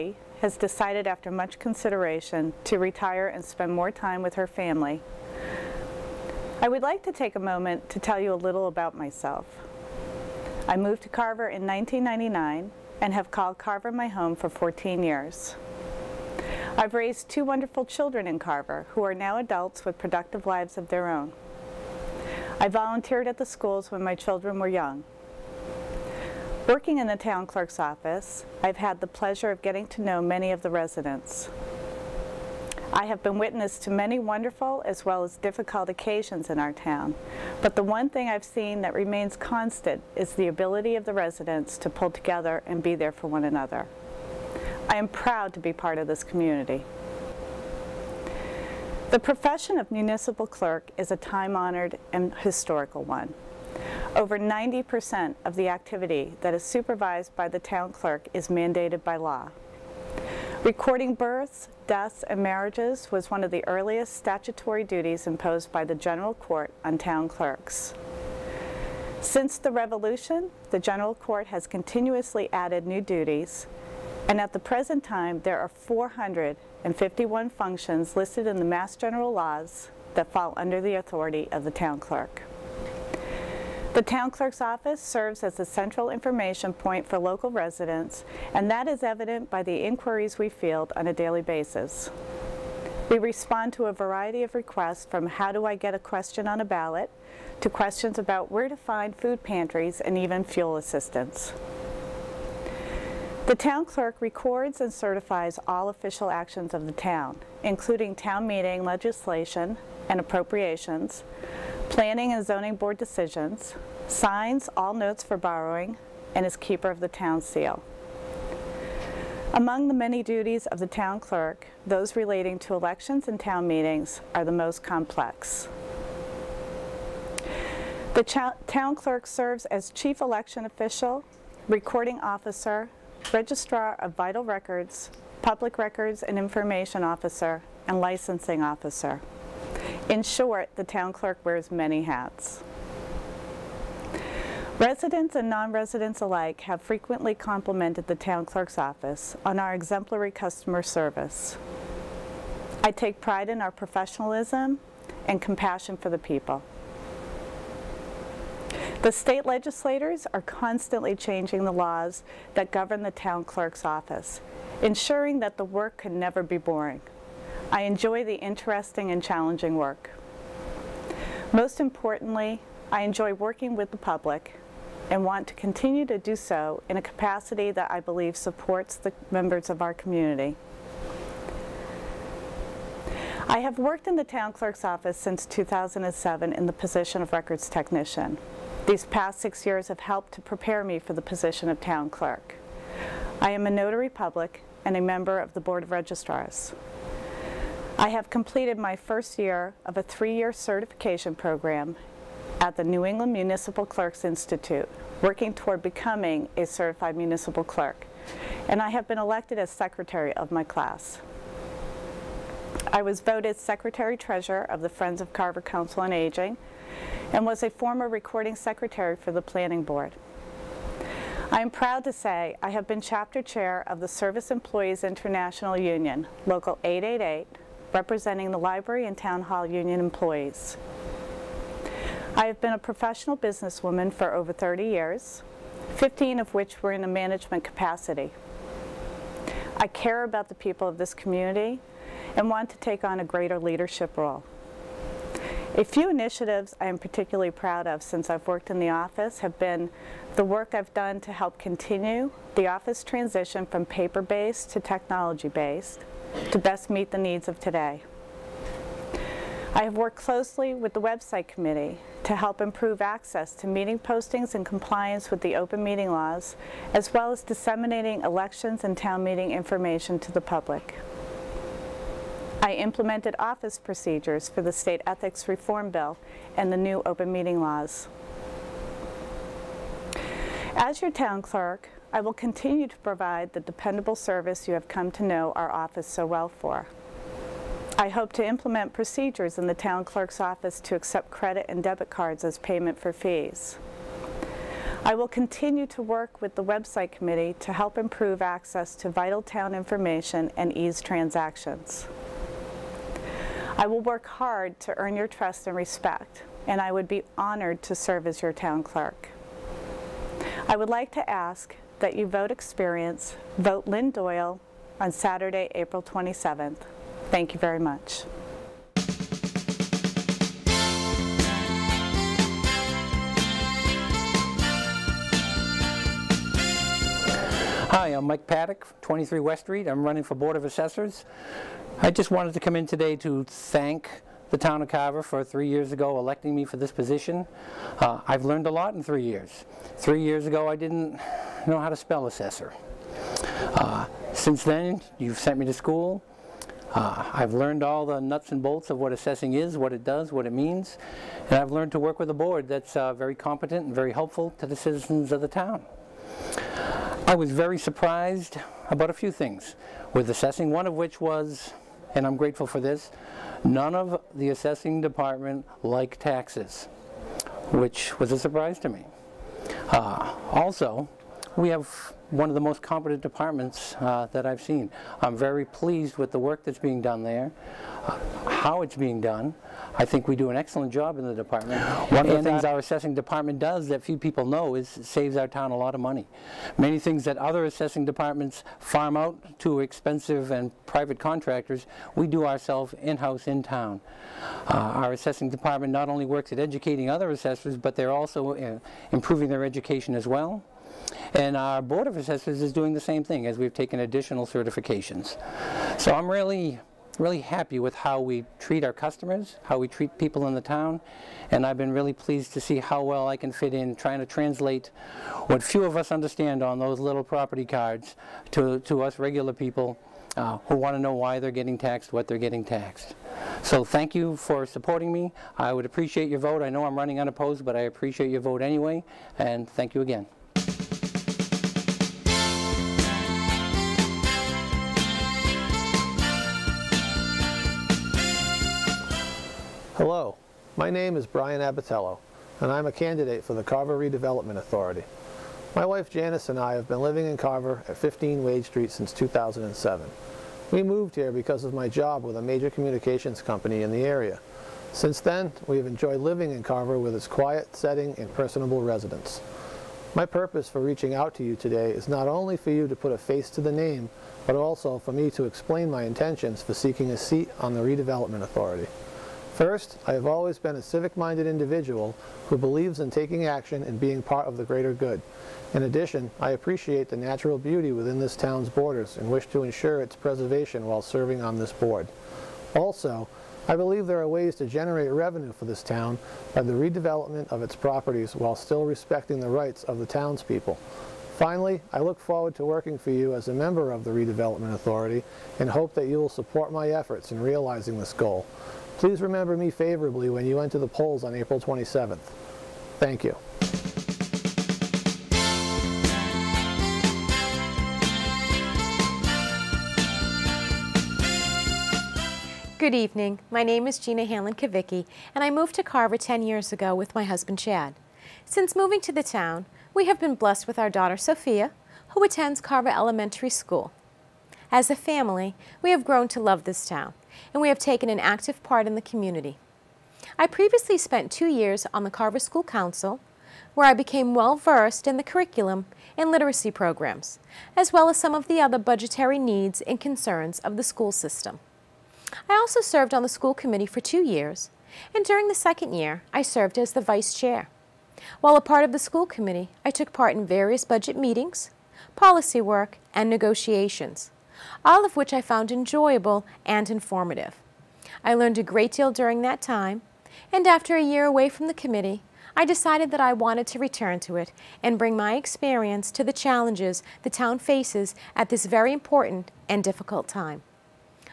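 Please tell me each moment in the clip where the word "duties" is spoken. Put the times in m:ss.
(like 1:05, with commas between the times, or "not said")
1:04, 1:13, 2:00.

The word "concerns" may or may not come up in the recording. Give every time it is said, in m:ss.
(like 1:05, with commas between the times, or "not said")
9:00.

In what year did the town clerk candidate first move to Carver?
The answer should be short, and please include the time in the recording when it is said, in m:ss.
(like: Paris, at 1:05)
1999, at 0:11.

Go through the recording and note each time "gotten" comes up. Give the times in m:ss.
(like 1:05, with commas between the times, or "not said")
not said.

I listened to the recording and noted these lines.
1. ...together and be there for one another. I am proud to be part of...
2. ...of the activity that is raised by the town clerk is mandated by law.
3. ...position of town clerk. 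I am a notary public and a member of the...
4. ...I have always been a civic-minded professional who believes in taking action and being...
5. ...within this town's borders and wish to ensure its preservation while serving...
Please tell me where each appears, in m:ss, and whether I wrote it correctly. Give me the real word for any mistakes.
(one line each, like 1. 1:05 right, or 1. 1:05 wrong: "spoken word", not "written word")
1. 0:42 right
2. 0:55 wrong: "supervised", not "raised"
3. 3:11 right
4. 7:50 wrong: "individual", not "professional"
5. 7:57 right.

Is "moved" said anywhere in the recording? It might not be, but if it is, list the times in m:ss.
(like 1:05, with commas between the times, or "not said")
0:10, 7:30, 8:35.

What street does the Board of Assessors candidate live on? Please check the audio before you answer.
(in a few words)
West Street.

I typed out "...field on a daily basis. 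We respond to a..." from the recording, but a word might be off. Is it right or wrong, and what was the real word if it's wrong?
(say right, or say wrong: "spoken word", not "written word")
right.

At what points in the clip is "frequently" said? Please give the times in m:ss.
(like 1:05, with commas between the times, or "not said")
2:26.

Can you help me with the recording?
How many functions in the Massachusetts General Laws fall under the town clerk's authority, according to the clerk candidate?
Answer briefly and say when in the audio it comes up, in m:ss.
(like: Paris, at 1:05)
451, at 1:15.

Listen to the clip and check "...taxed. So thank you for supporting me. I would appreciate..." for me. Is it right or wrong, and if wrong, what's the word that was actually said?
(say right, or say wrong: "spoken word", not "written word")
right.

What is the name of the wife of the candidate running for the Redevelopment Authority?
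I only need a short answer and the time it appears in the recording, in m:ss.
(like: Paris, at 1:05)
Janice, at 7:26.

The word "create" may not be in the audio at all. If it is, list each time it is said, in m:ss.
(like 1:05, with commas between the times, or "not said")
not said.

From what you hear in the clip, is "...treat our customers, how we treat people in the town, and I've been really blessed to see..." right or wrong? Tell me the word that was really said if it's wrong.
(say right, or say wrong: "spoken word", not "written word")
wrong: "pleased", not "blessed".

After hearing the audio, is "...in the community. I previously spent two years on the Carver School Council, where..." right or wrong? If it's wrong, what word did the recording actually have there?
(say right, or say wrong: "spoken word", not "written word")
right.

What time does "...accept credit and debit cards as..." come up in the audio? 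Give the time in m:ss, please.
4:50.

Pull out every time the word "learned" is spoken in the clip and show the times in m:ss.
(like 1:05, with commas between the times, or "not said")
5:38, 5:47, 5:51, 9:18.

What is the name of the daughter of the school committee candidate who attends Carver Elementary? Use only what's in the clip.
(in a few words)
Sophia.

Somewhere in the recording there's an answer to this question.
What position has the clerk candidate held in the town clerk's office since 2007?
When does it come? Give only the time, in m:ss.
3:07.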